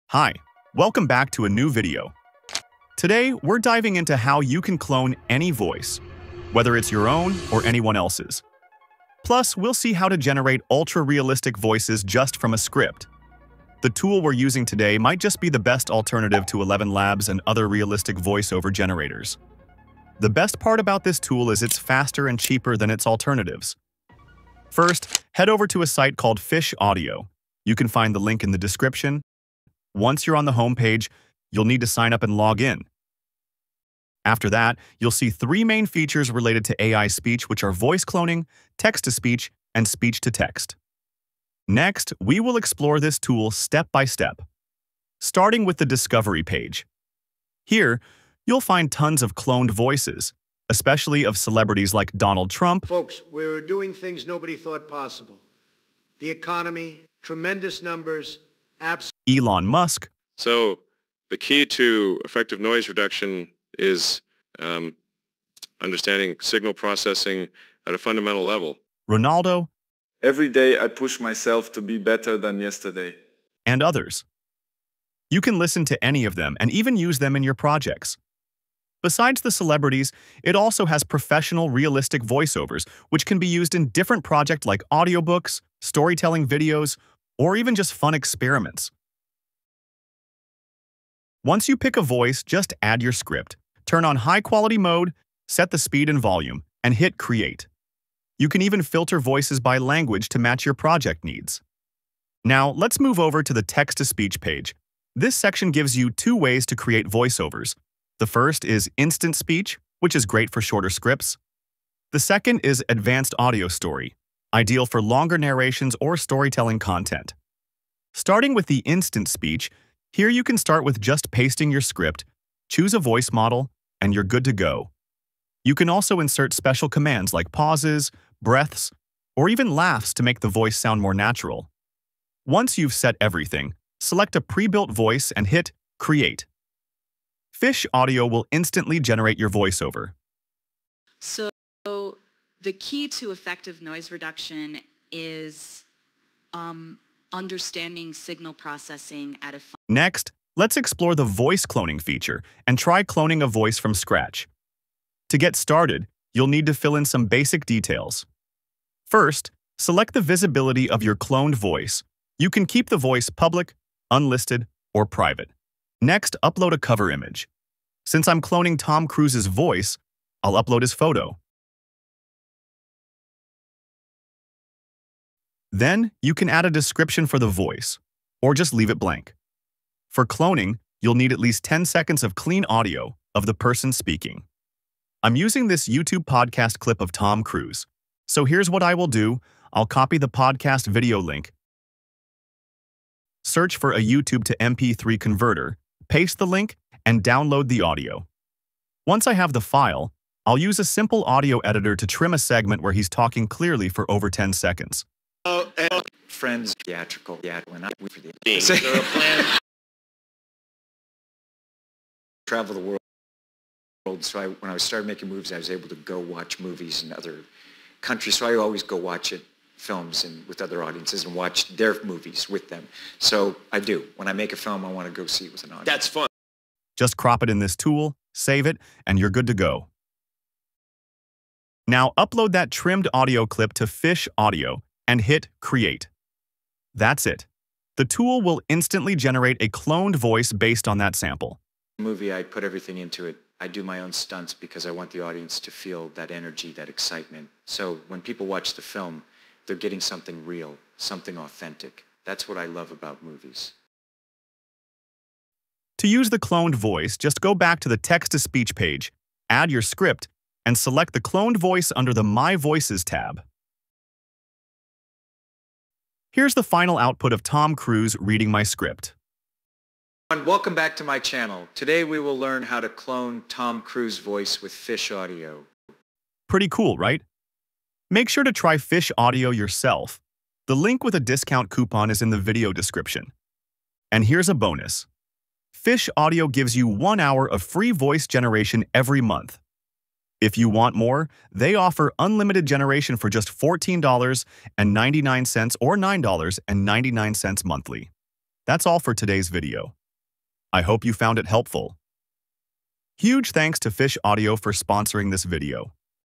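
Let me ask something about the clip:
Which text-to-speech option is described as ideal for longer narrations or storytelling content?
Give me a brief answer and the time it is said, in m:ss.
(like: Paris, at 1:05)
Advanced audio story, at 1:52.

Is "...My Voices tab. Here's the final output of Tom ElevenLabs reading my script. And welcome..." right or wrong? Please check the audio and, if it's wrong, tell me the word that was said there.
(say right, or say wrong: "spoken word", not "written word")
wrong: "Cruise", not "ElevenLabs".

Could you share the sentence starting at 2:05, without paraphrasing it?
You can also insert special commands like pauses, breaths, or even laughs to make the voice sound more natural.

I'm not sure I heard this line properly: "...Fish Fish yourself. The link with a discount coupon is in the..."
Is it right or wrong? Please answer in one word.
wrong.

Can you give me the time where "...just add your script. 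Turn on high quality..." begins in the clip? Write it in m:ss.
1:32.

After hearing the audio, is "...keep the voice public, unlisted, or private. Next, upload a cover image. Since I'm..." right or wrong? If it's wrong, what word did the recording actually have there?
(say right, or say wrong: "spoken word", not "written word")
right.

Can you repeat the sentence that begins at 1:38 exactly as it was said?
You can even filter voices by language to match your project needs.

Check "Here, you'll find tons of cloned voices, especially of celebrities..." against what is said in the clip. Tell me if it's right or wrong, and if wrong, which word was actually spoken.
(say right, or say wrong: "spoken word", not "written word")
right.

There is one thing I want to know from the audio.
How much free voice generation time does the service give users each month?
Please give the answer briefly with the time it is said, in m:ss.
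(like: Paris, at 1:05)
One hour, at 4:46.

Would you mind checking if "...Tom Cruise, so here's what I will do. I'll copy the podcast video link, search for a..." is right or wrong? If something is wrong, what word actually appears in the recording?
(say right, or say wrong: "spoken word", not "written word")
right.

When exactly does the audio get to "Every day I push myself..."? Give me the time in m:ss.
1:10.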